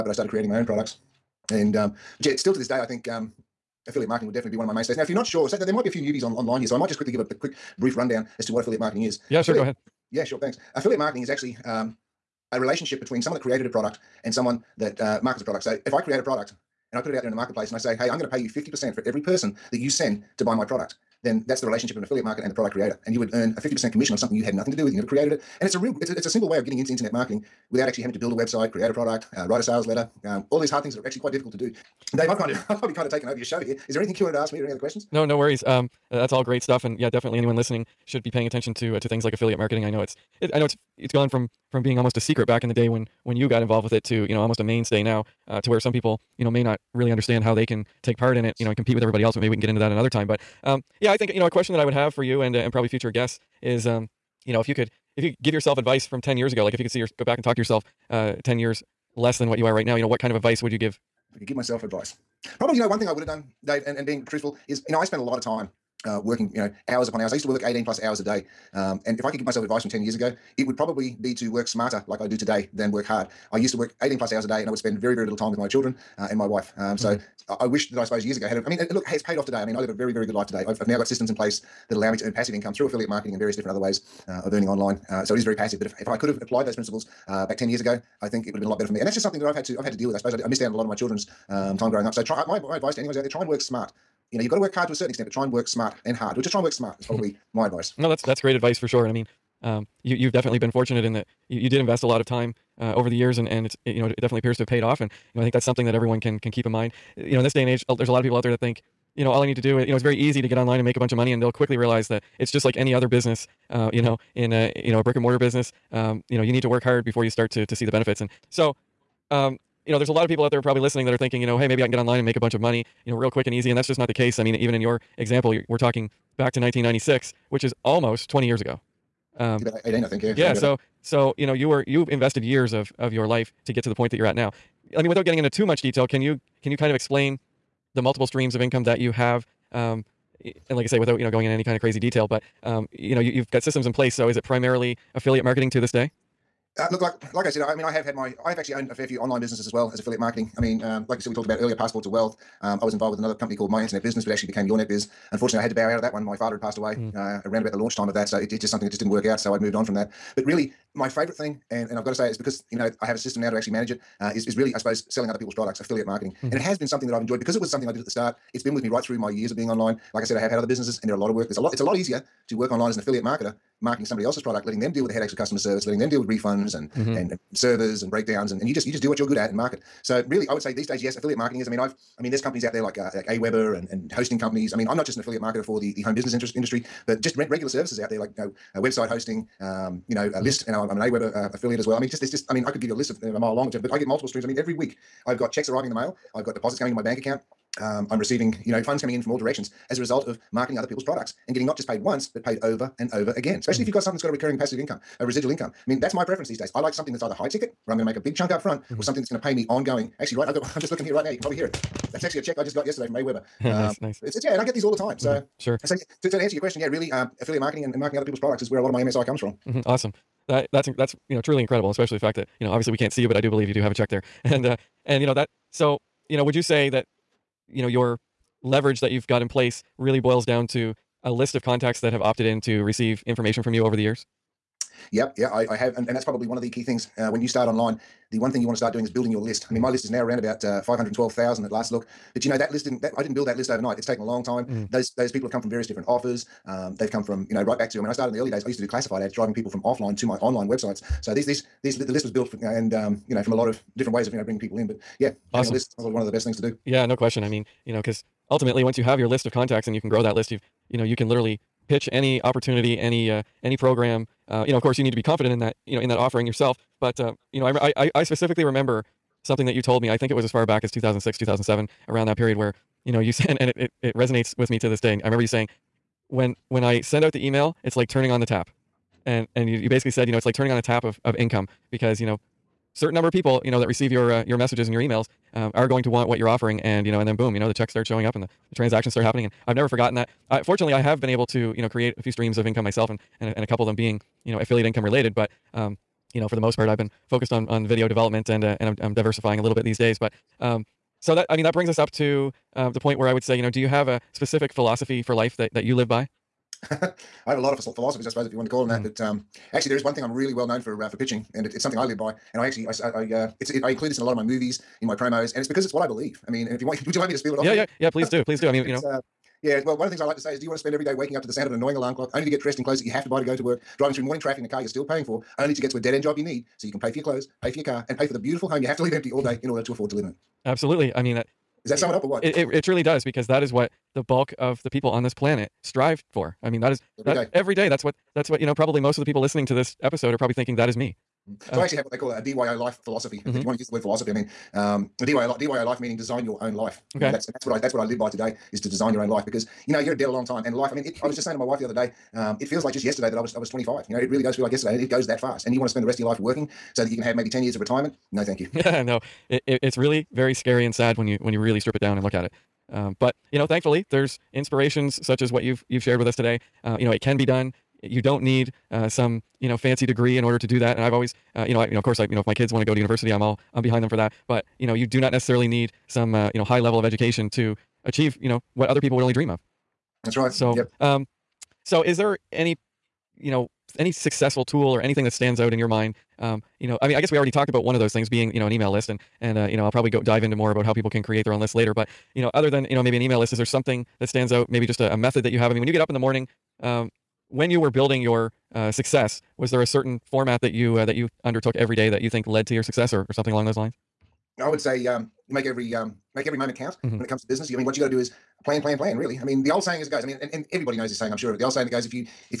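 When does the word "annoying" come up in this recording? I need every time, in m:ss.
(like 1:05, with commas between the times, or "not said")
5:21.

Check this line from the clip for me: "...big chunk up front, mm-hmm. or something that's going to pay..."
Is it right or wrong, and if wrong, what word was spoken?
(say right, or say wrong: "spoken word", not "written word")
right.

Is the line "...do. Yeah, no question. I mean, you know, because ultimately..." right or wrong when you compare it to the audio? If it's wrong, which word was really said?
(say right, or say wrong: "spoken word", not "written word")
right.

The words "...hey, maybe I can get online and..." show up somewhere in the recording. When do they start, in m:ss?
2:01.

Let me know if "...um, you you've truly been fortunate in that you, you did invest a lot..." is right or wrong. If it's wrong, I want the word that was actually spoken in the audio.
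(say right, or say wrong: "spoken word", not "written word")
wrong: "definitely", not "truly".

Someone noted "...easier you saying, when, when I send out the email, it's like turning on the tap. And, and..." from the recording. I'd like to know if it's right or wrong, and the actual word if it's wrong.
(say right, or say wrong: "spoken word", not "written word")
wrong: "remember", not "easier".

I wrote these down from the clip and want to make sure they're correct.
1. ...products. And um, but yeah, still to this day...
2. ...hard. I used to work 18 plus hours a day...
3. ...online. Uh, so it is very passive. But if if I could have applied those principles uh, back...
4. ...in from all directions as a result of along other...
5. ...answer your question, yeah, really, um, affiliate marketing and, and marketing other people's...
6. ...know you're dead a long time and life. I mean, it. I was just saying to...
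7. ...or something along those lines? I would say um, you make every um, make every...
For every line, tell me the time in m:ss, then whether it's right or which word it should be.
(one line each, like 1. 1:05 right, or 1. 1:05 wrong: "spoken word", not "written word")
1. 0:00 right
2. 1:13 right
3. 1:24 right
4. 3:19 wrong: "marketing", not "along"
5. 3:36 right
6. 5:49 right
7. 6:43 right.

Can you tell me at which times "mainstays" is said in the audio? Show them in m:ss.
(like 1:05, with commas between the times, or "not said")
0:04, 0:44.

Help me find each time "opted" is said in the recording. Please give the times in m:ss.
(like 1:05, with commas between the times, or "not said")
3:52.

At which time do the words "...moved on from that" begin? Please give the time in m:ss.
2:39.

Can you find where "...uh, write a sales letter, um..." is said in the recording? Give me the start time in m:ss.
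0:29.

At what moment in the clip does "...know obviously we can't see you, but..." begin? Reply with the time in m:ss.
3:42.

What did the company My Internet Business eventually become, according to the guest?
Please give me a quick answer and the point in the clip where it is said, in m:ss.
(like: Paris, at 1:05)
Your Net Biz, at 2:34.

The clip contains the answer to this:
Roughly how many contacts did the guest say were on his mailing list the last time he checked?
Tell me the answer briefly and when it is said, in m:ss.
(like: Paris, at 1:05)
512,000, at 4:00.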